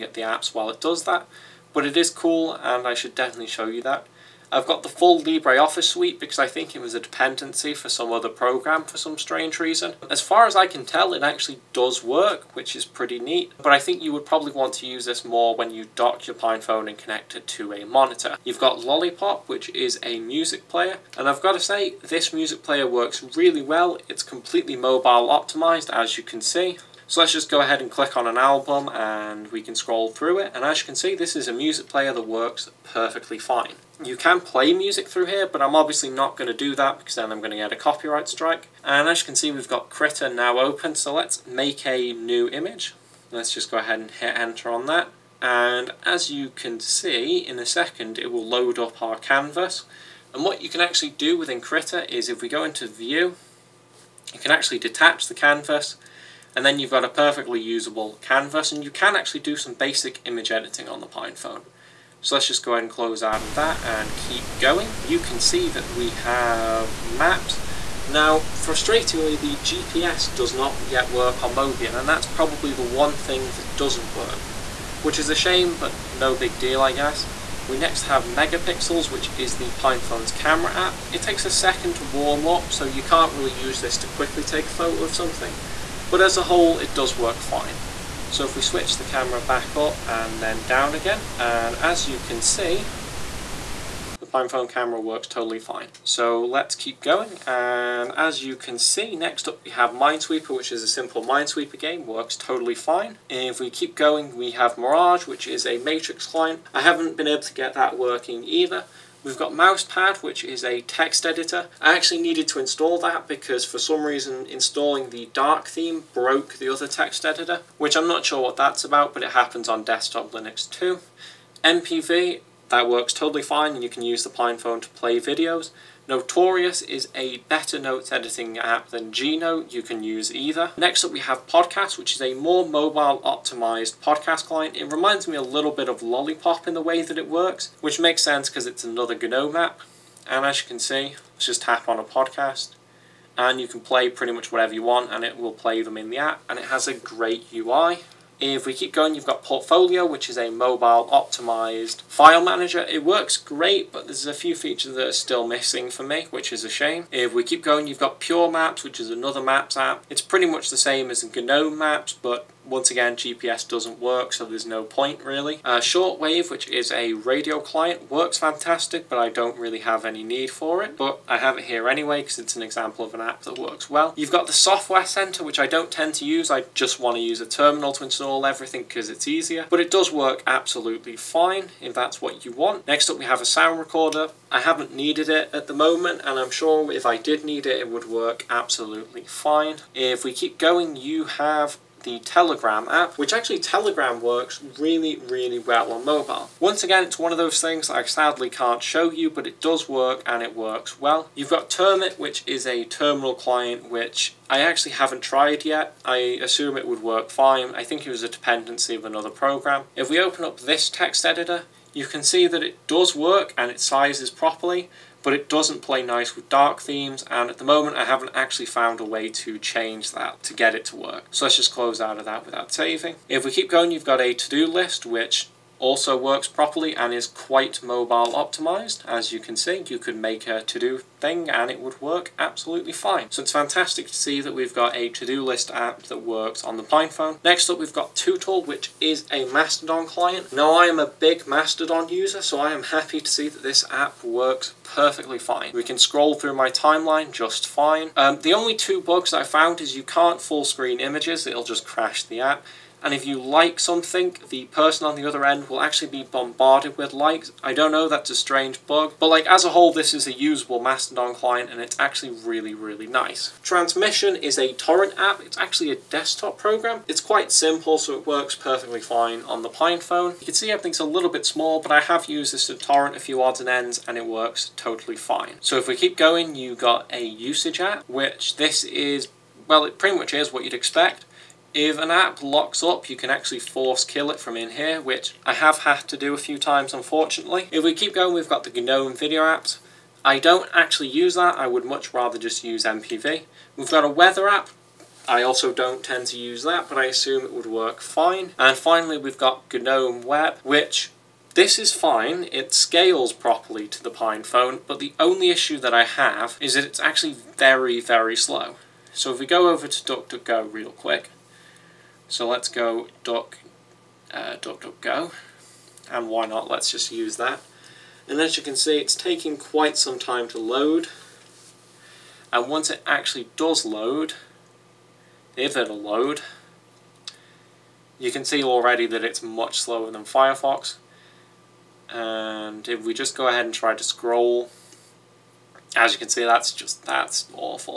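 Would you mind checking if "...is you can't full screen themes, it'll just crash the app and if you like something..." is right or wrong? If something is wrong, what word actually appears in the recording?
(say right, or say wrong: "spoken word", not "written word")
wrong: "images", not "themes".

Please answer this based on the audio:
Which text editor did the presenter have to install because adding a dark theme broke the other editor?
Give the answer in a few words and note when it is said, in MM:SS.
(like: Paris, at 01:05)
Mousepad, at 01:49.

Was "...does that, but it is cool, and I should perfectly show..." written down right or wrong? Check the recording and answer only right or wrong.
wrong.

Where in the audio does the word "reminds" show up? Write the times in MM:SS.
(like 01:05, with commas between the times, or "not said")
02:14.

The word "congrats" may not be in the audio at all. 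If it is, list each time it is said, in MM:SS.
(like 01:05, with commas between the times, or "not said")
not said.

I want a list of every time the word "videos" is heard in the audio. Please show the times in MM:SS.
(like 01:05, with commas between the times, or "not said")
02:05, 04:49.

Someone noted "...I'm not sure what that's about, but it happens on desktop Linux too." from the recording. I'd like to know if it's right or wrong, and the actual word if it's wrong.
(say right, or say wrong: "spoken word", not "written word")
right.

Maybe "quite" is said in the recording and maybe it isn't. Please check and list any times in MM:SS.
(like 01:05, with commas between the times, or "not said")
03:47, 04:27, 05:19.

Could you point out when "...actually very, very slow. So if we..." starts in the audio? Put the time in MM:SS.
05:06.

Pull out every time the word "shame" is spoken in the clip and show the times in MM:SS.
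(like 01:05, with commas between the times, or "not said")
01:15, 02:36.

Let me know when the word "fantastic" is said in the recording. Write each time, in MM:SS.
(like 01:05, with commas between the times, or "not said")
02:48, 03:53.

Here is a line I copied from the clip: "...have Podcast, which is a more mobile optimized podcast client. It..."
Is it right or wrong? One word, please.
right.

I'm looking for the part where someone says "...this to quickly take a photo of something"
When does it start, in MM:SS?
01:23.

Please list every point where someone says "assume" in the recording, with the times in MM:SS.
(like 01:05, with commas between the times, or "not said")
03:26, 04:57.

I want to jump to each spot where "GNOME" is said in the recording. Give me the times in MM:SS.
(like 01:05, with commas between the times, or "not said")
02:19, 02:41, 04:48, 04:59.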